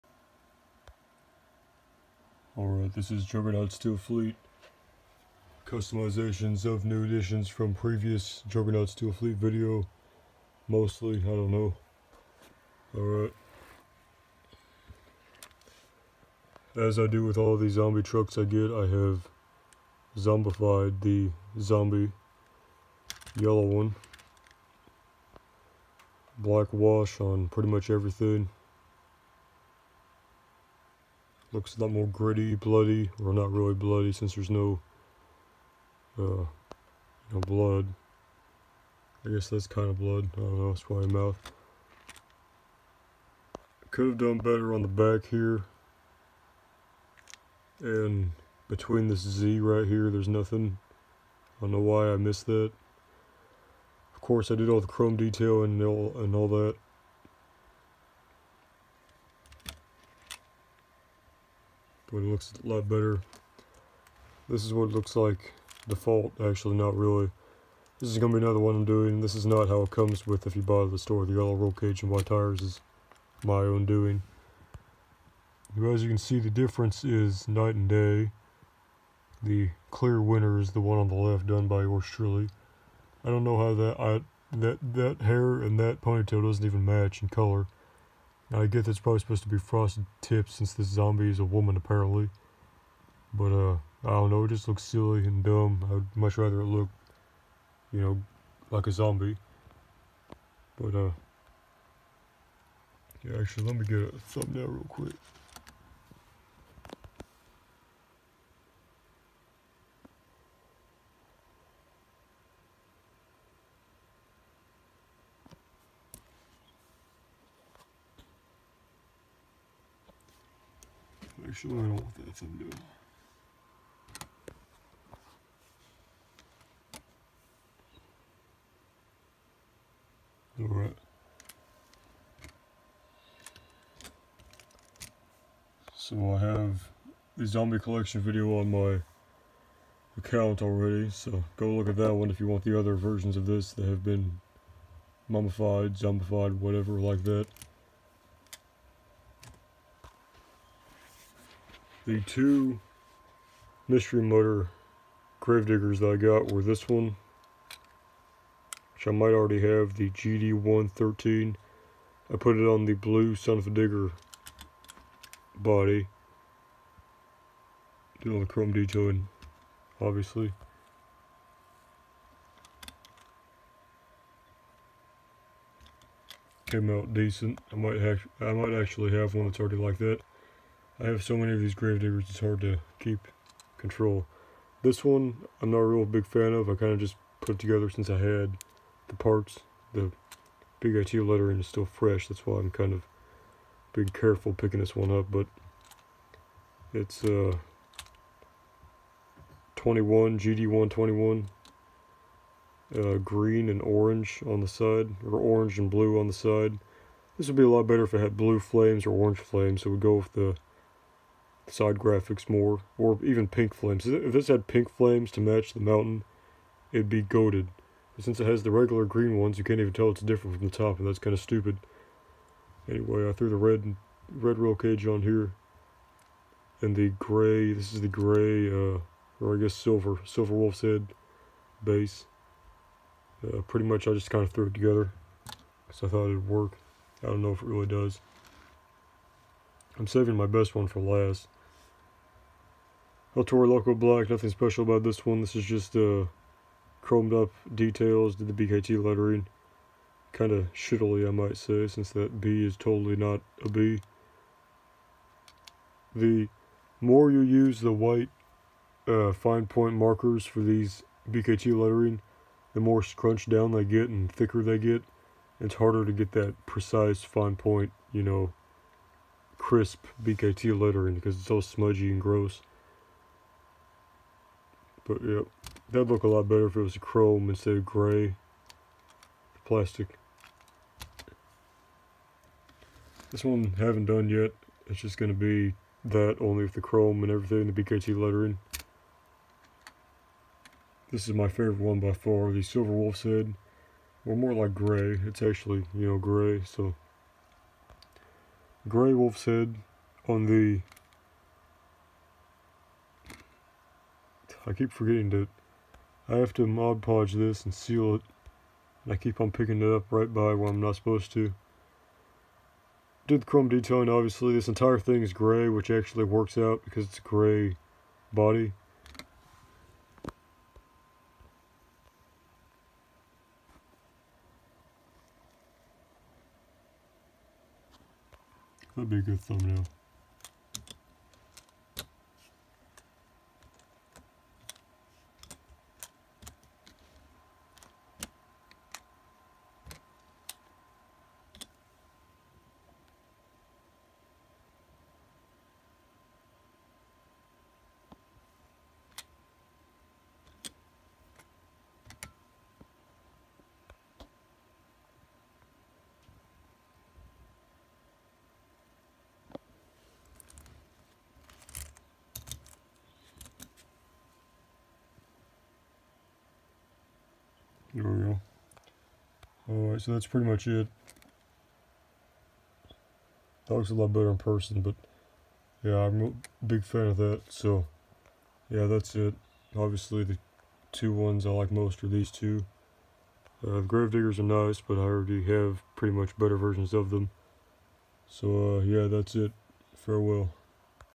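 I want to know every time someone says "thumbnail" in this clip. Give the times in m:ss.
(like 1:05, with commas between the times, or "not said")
1:44, 5:29.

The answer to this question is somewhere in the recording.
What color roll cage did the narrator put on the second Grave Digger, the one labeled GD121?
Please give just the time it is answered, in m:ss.
3:43.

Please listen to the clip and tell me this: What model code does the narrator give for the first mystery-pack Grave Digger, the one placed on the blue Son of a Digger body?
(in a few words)
GD113.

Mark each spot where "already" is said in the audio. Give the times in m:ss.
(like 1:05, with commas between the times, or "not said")
2:20, 2:39, 2:59, 6:25.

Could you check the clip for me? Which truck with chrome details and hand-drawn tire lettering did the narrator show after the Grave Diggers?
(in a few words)
El Toro Loco Black.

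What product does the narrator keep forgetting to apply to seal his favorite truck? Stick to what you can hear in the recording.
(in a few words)
Mod Podge.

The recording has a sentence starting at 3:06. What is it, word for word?
I kind of just put it together since I had the parts.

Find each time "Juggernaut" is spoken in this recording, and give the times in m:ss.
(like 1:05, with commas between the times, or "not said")
0:03, 0:08.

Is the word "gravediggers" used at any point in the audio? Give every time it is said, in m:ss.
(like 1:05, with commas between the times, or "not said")
2:35, 3:01, 6:23.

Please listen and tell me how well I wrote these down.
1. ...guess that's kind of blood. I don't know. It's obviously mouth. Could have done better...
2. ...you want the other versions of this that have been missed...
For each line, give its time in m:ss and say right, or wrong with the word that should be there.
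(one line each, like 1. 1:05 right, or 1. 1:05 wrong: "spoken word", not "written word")
1. 0:39 wrong: "probably", not "obviously"
2. 2:22 wrong: "mummified", not "missed".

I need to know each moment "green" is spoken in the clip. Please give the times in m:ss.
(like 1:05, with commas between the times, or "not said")
3:23, 3:39.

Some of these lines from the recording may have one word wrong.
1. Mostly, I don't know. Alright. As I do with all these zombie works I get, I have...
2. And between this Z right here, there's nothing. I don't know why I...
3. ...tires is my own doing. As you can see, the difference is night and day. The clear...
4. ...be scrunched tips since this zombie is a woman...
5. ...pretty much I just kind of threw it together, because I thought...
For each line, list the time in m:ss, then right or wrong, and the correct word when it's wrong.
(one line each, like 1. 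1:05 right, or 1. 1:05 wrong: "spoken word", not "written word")
1. 0:10 wrong: "trucks", not "works"
2. 0:47 right
3. 1:12 right
4. 1:29 wrong: "frosted", not "scrunched"
5. 3:53 right.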